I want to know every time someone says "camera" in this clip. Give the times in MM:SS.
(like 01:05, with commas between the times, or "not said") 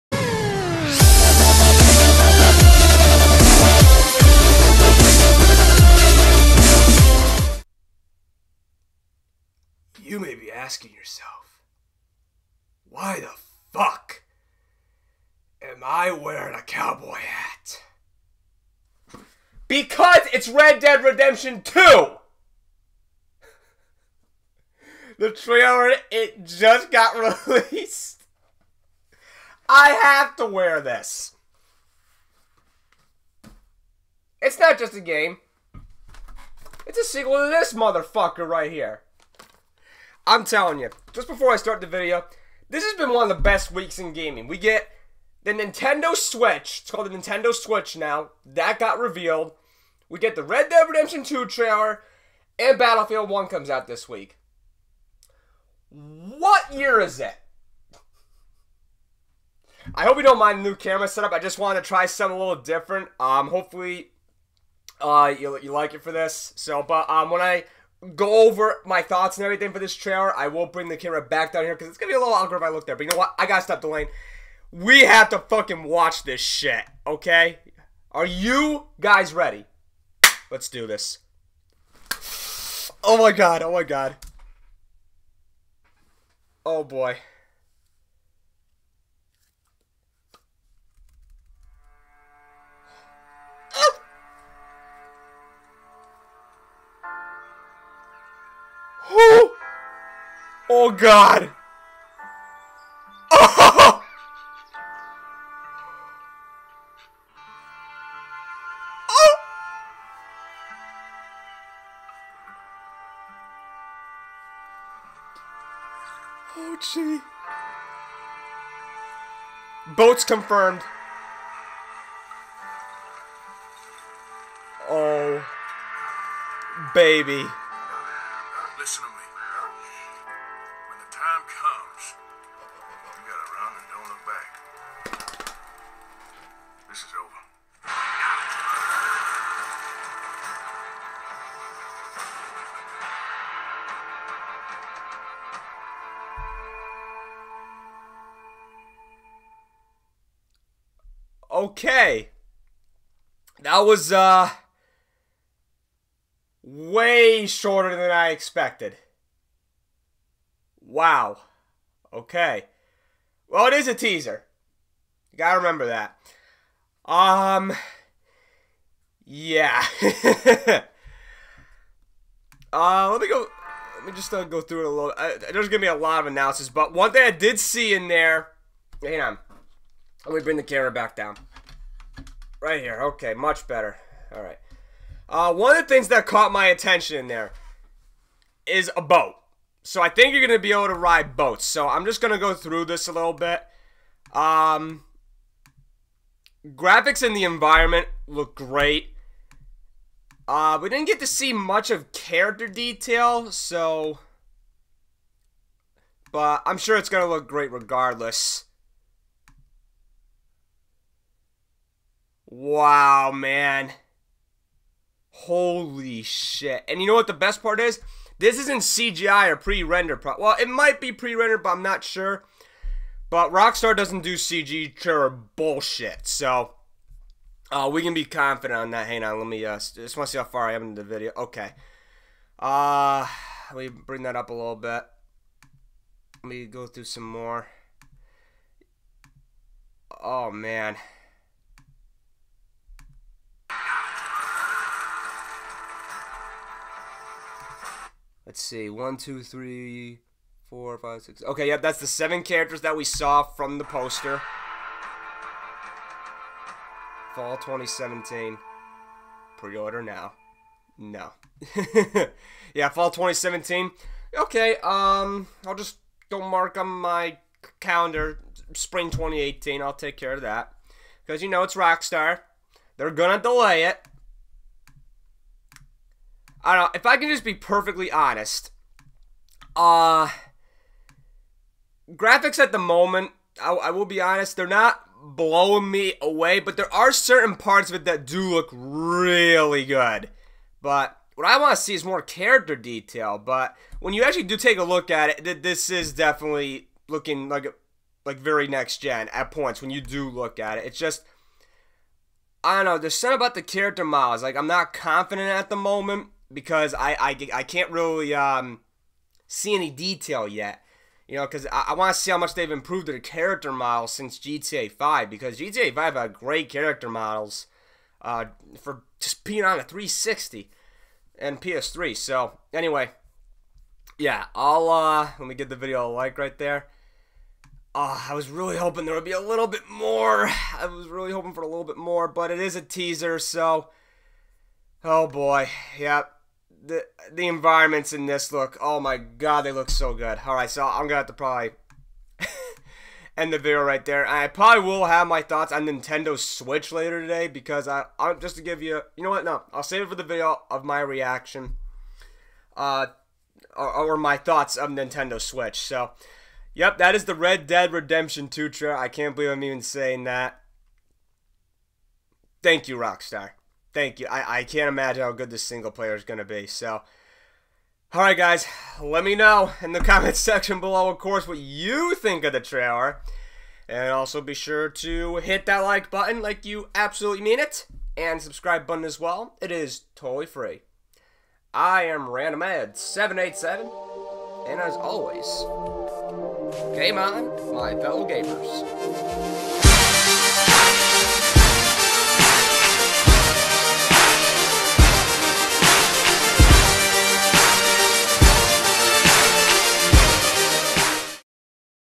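01:00, 01:10, 03:00.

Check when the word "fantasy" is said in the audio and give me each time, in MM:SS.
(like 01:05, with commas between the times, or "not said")
not said.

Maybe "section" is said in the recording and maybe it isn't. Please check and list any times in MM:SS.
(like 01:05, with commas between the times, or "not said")
06:10.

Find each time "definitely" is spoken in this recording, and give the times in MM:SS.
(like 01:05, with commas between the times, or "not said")
04:56.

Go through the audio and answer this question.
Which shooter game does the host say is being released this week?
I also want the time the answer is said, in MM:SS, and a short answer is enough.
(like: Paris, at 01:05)
Battlefield 1, at 00:52.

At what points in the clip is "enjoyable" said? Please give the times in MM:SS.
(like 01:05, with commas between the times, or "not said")
not said.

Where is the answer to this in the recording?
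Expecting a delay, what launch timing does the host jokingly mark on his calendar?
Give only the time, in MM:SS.
04:28.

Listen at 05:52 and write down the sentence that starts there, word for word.
Uh, or, or my thoughts of Nintendo Switch.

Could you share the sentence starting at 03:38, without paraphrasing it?
This isn't CGI or pre rendered Pro- well, it might be pre-rendered, but I'm not sure.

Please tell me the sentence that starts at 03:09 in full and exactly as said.
So I think you're going to be able to ride boats.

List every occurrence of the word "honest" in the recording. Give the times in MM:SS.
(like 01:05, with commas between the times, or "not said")
04:38, 04:44.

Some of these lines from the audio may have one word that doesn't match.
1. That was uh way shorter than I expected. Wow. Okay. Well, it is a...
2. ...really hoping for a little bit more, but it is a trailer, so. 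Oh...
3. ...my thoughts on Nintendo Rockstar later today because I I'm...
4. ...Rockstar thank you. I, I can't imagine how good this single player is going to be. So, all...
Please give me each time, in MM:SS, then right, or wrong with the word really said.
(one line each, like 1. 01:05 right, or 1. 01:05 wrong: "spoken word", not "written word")
1. 02:33 right
2. 05:31 wrong: "teaser", not "trailer"
3. 05:45 wrong: "Switch", not "Rockstar"
4. 06:02 right.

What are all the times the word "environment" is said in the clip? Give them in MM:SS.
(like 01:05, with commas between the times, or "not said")
03:17, 05:37.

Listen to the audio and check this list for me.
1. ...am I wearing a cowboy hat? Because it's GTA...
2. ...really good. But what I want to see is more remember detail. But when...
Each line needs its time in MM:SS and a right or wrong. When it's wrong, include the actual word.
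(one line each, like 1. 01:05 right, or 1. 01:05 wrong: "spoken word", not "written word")
1. 00:15 wrong: "Red", not "GTA"
2. 04:48 wrong: "character", not "remember".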